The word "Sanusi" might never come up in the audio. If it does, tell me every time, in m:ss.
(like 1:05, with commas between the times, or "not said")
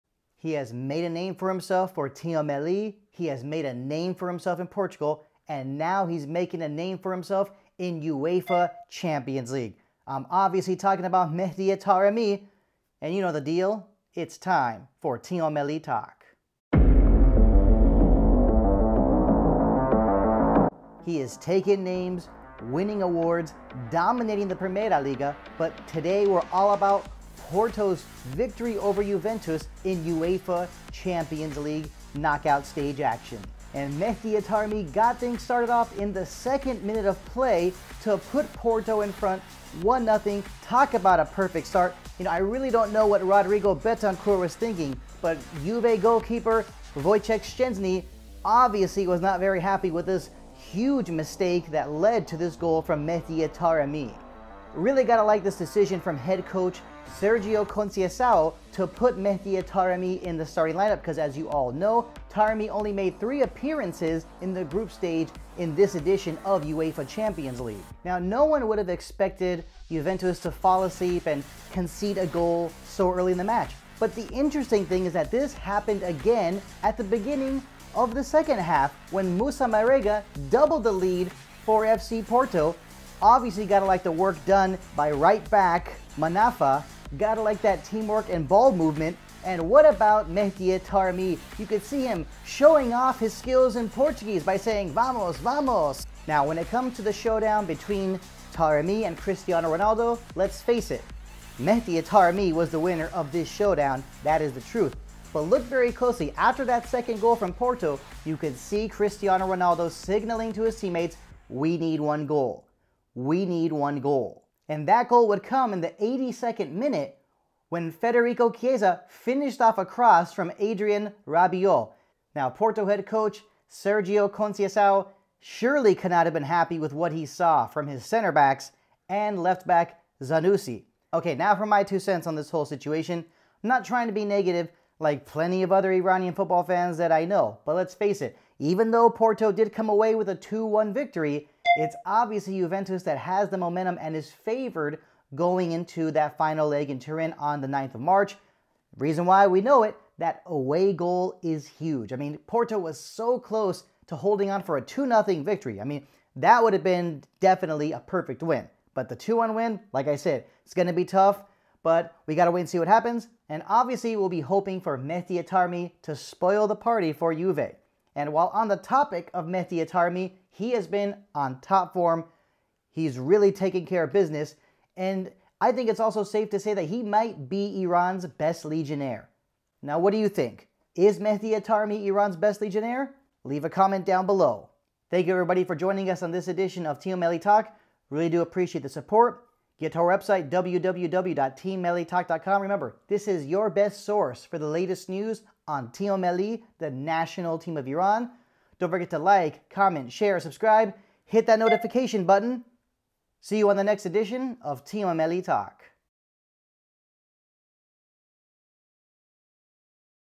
2:10.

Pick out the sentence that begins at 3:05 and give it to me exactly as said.
Thank you, everybody, for joining us on this edition of Team Melli Talk.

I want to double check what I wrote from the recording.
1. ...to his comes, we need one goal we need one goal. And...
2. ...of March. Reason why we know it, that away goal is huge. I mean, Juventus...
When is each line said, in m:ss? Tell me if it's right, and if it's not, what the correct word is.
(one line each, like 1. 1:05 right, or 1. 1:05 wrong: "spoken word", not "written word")
1. 1:50 wrong: "teammates", not "comes"
2. 2:27 wrong: "Porto", not "Juventus".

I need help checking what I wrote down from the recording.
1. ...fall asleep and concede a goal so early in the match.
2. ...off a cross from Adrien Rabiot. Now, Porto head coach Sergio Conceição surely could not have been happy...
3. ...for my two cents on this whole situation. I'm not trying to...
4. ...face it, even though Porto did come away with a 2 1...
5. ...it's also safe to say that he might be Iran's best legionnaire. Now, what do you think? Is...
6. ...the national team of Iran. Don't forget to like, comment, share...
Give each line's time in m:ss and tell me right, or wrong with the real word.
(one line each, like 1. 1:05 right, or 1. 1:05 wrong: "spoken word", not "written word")
1. 1:10 right
2. 1:59 right
3. 2:11 right
4. 2:17 right
5. 2:55 right
6. 3:16 right.